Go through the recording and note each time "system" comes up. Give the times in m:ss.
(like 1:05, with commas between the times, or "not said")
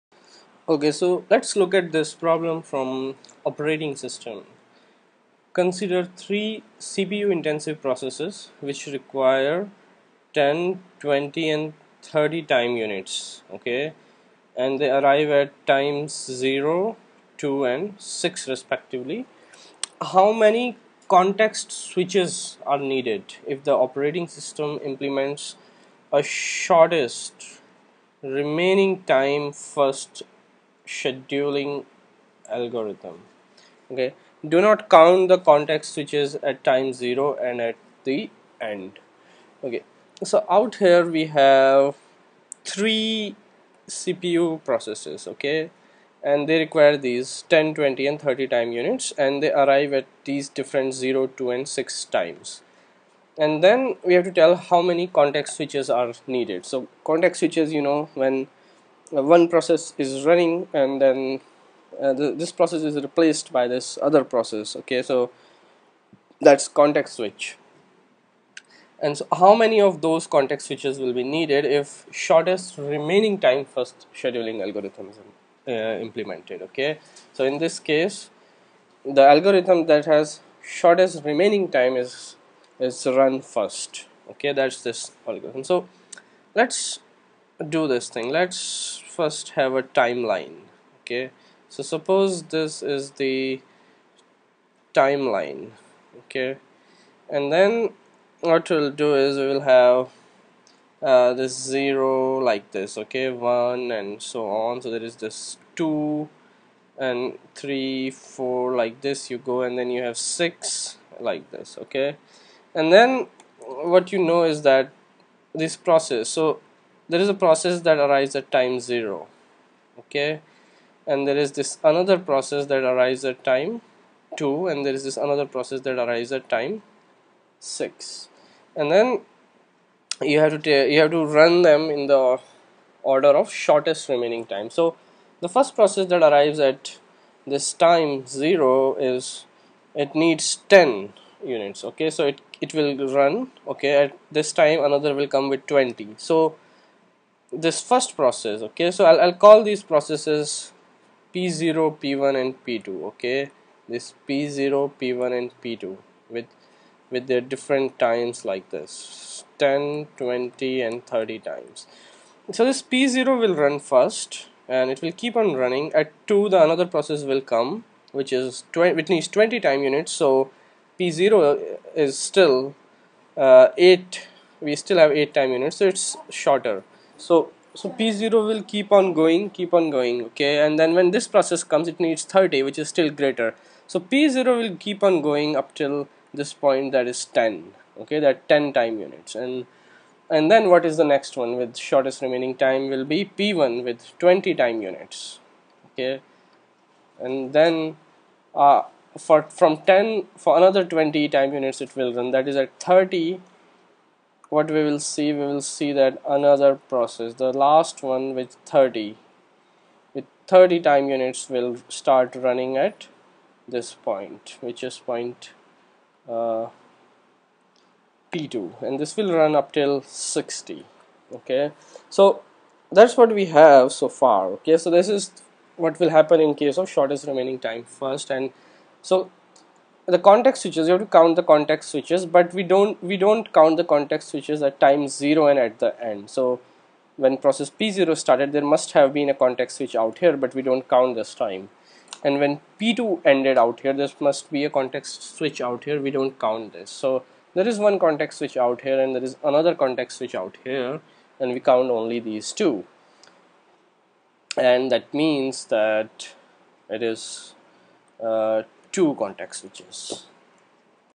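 0:03, 0:24.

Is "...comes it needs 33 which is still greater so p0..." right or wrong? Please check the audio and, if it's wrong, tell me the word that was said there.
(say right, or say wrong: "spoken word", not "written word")
wrong: "30", not "33".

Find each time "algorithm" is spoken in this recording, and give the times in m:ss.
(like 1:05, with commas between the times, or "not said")
0:32, 1:14, 1:19, 1:25.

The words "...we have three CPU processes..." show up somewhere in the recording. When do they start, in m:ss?
0:41.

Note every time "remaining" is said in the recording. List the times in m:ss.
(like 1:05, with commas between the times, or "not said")
0:28, 1:12, 1:21, 2:14, 3:12, 3:47.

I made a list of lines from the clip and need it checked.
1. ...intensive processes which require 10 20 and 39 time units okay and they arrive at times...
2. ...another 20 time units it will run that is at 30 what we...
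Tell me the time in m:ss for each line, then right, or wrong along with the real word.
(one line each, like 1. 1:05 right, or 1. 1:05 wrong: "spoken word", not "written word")
1. 0:07 wrong: "30", not "39"
2. 3:20 right.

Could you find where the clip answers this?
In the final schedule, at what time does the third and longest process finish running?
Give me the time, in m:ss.
3:40.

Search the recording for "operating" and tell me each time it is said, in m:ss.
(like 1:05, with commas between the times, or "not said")
0:03, 0:23.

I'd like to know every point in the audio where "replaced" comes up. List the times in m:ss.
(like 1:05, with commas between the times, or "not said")
1:02.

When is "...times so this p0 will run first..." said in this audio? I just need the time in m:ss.
2:41.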